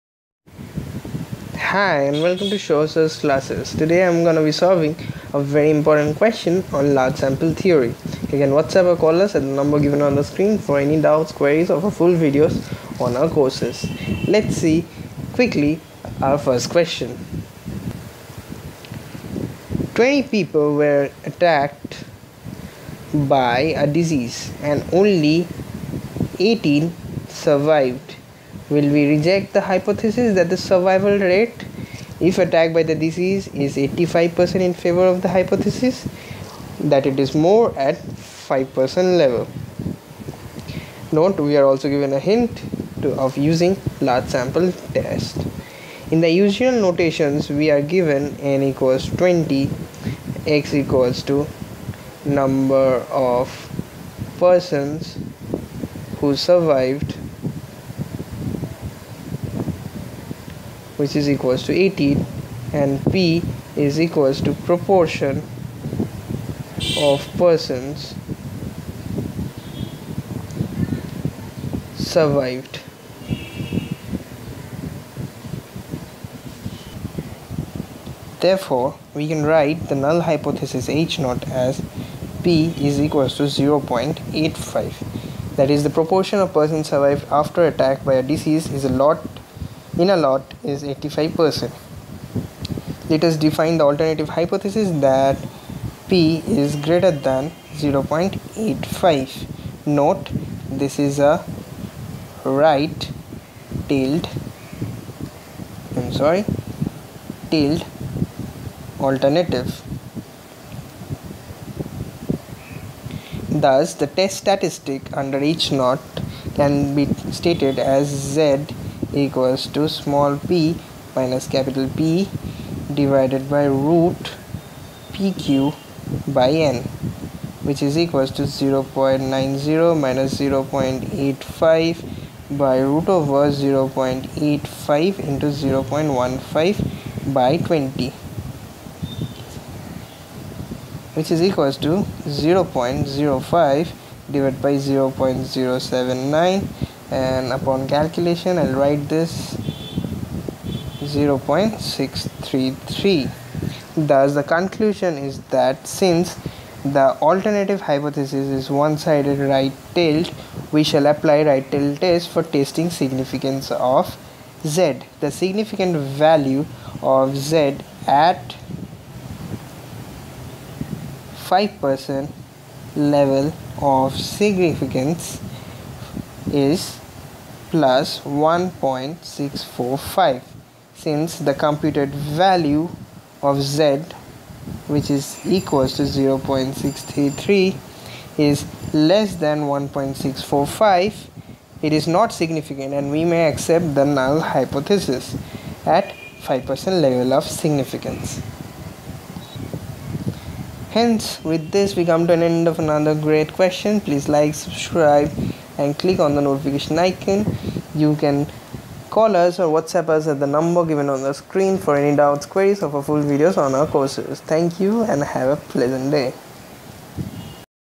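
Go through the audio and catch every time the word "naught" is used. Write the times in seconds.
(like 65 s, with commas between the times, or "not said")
81 s, 115 s.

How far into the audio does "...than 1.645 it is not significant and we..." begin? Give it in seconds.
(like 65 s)
189 s.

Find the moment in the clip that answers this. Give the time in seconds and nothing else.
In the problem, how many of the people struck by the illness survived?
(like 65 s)
26 s.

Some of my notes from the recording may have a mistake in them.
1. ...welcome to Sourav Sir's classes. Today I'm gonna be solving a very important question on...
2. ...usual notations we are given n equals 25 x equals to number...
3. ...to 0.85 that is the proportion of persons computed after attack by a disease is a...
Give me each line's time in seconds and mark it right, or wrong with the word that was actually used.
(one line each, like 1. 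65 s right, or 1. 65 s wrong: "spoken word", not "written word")
1. 2 s right
2. 46 s wrong: "20", not "25"
3. 83 s wrong: "survived", not "computed".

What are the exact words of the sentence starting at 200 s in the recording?
Hence, with this, we come to an end of another great question.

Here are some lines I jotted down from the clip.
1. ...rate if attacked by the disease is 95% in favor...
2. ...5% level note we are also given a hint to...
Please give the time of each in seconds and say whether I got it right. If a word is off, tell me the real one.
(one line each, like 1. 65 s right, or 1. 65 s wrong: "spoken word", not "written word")
1. 31 s wrong: "85", not "95"
2. 37 s right.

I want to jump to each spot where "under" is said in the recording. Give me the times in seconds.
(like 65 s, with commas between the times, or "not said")
115 s.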